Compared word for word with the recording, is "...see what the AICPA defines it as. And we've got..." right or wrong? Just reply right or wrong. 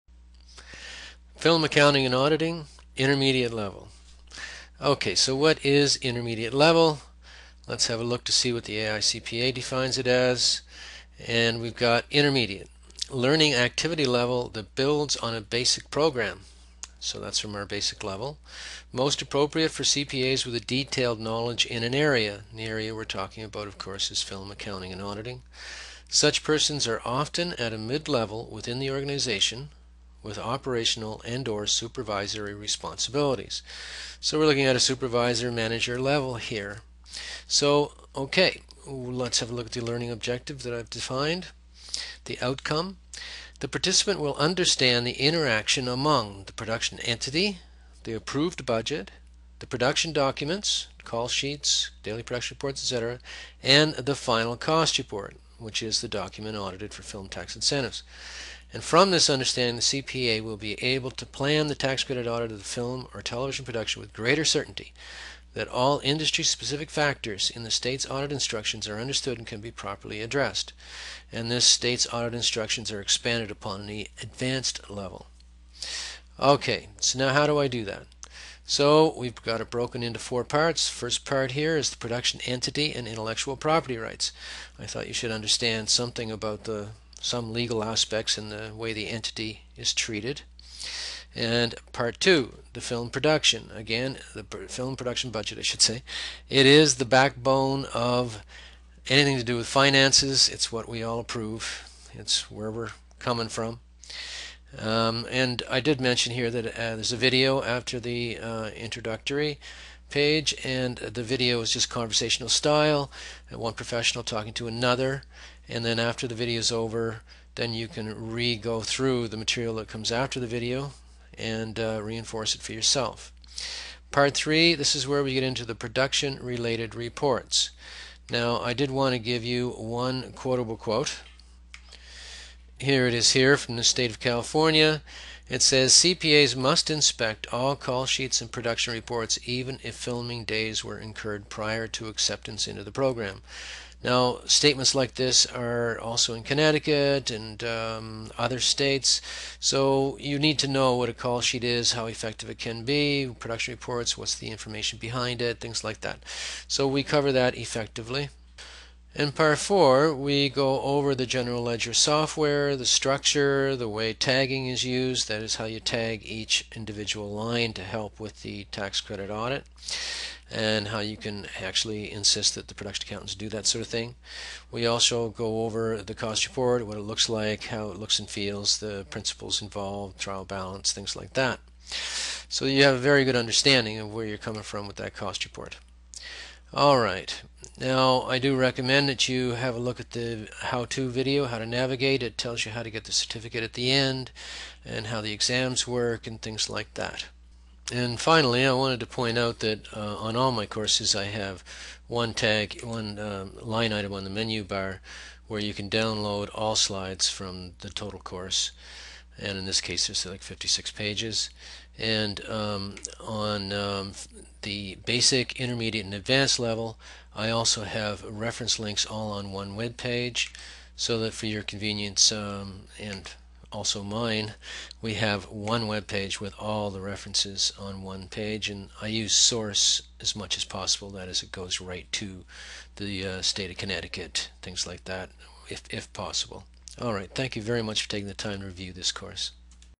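right.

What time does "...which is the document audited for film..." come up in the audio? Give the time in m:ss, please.
0:55.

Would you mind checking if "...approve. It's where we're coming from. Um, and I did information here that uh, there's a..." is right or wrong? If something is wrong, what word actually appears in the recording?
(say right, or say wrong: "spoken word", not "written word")
wrong: "mention", not "information".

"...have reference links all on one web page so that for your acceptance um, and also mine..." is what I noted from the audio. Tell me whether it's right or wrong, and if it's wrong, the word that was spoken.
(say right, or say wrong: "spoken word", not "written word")
wrong: "convenience", not "acceptance".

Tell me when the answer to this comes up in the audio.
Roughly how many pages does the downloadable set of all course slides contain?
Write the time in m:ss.
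3:30.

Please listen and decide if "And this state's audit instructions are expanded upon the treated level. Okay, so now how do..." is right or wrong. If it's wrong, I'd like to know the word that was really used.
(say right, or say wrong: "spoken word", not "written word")
wrong: "advanced", not "treated".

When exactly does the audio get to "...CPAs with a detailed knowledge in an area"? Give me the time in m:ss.
0:19.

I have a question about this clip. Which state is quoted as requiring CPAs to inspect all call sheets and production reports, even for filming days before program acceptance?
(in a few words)
California.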